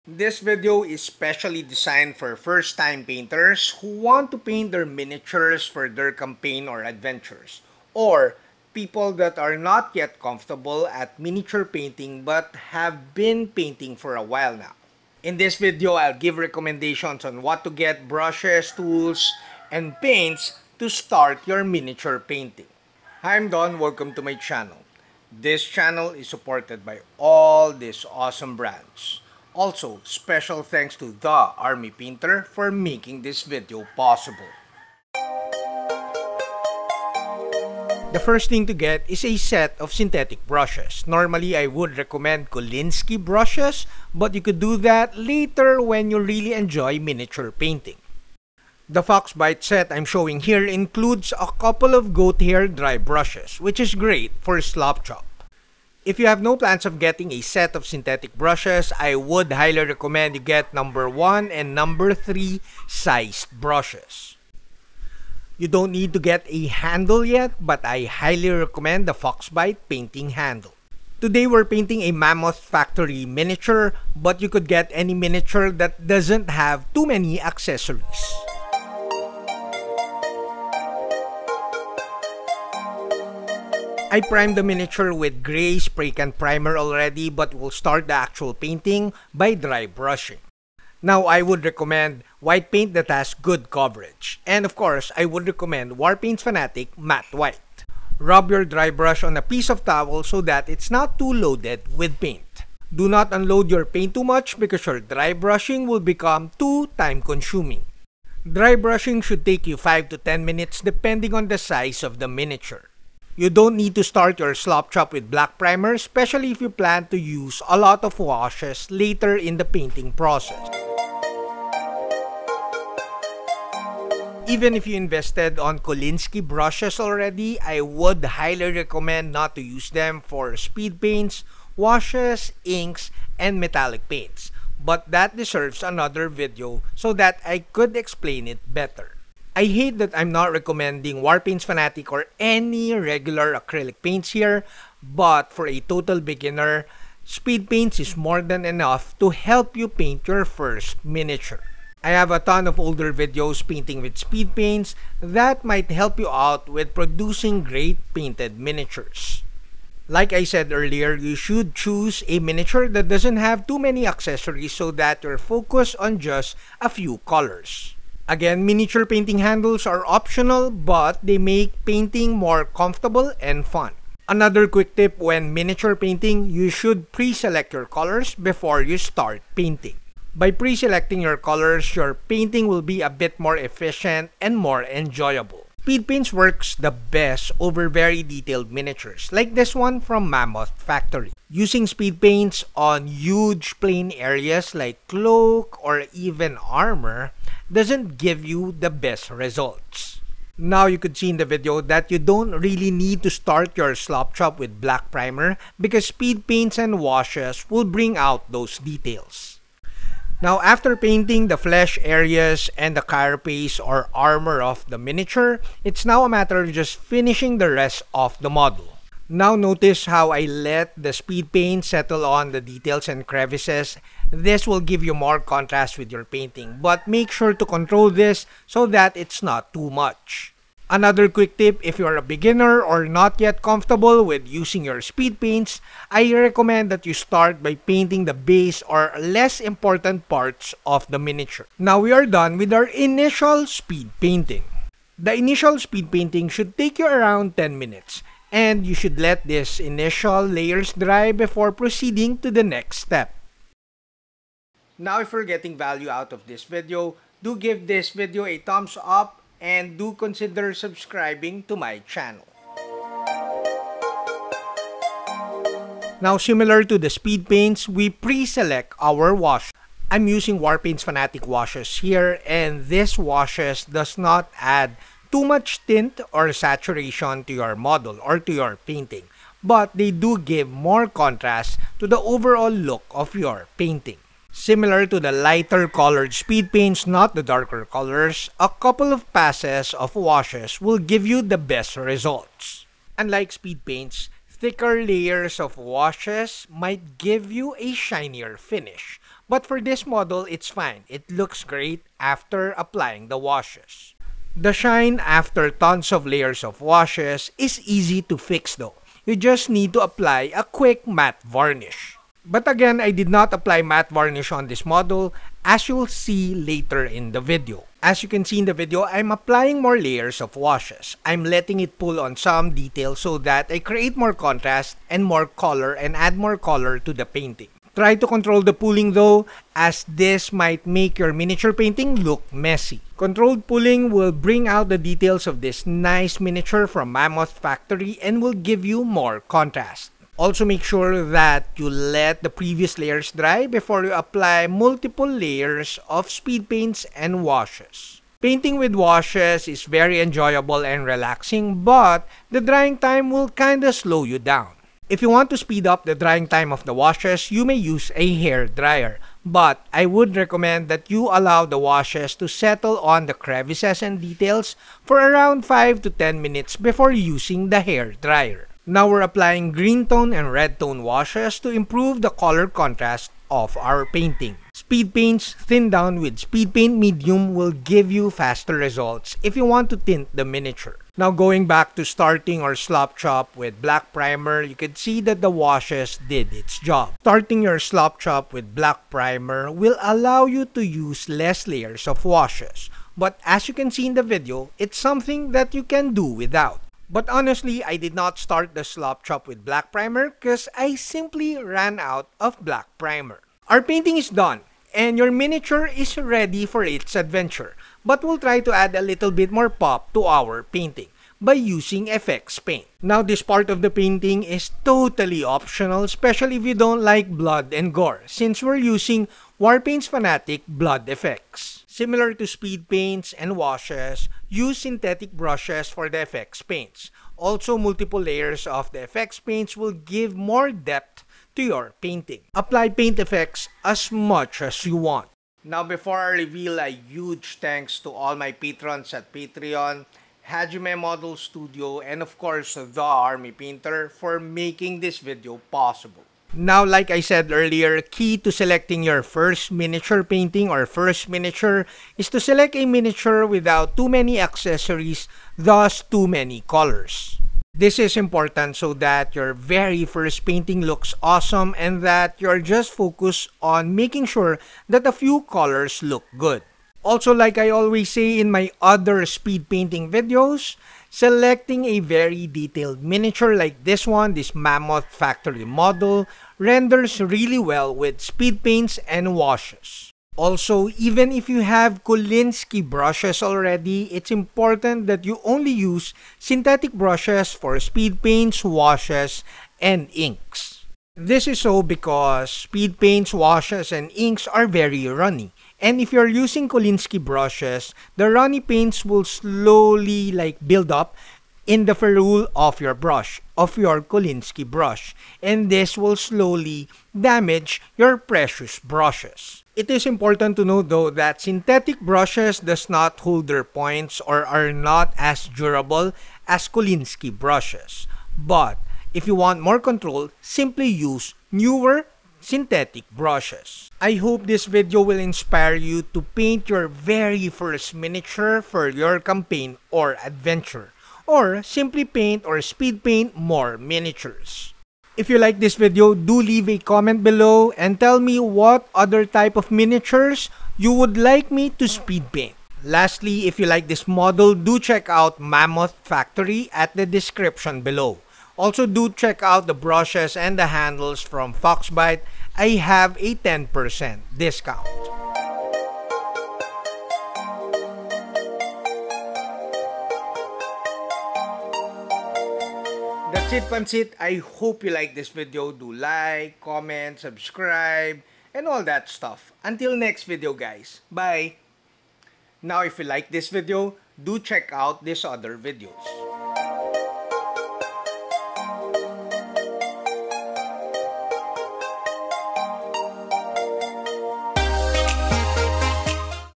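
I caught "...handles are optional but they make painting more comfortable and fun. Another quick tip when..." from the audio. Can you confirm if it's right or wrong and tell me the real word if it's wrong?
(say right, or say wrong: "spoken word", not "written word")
right.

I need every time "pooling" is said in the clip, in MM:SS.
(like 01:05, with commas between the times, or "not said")
05:28, 05:33.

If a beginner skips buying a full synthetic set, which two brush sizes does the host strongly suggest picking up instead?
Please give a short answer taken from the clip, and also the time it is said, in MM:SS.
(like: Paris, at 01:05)
1 and 3, at 01:00.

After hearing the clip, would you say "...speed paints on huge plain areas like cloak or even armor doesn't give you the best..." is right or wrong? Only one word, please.
right.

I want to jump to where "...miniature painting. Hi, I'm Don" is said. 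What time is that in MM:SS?
00:21.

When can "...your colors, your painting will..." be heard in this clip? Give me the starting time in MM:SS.
03:01.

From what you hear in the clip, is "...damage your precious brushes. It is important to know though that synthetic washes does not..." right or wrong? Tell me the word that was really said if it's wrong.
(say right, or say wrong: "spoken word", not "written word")
wrong: "brushes", not "washes".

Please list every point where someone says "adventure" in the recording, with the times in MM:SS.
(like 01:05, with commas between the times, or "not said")
00:06, 06:47, 08:50.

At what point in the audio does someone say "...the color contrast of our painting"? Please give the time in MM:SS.
06:12.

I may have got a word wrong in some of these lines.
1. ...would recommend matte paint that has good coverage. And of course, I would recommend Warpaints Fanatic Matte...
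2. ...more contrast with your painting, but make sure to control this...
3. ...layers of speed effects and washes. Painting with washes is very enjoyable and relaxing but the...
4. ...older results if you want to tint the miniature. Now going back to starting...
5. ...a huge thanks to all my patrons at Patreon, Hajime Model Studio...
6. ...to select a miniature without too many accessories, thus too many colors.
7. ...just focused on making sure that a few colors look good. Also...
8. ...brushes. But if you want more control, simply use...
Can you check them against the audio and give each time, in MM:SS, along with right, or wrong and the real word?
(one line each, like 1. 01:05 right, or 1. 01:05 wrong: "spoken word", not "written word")
1. 01:31 wrong: "white", not "matte"
2. 03:45 right
3. 05:45 wrong: "paints", not "effects"
4. 06:18 wrong: "faster", not "older"
5. 07:16 right
6. 07:32 right
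7. 07:42 right
8. 08:37 right.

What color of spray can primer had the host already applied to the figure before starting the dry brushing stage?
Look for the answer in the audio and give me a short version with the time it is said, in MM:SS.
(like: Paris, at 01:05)
Gray, at 01:25.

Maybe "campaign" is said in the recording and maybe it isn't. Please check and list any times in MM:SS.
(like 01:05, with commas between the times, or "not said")
00:06, 08:49.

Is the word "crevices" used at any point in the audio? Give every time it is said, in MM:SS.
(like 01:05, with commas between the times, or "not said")
03:43, 06:03.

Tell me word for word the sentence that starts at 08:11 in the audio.
This is so because speed paints, washes, and inks are very runny.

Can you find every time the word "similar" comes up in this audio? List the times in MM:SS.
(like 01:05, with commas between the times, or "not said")
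04:26, 04:44, 07:01.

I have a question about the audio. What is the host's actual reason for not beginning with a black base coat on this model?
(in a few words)
Ran out of black primer.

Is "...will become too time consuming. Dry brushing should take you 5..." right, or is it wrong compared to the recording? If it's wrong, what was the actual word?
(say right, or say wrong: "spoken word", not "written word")
right.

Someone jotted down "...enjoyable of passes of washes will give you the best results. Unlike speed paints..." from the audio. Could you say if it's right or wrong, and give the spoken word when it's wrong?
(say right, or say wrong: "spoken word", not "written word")
wrong: "couple", not "enjoyable".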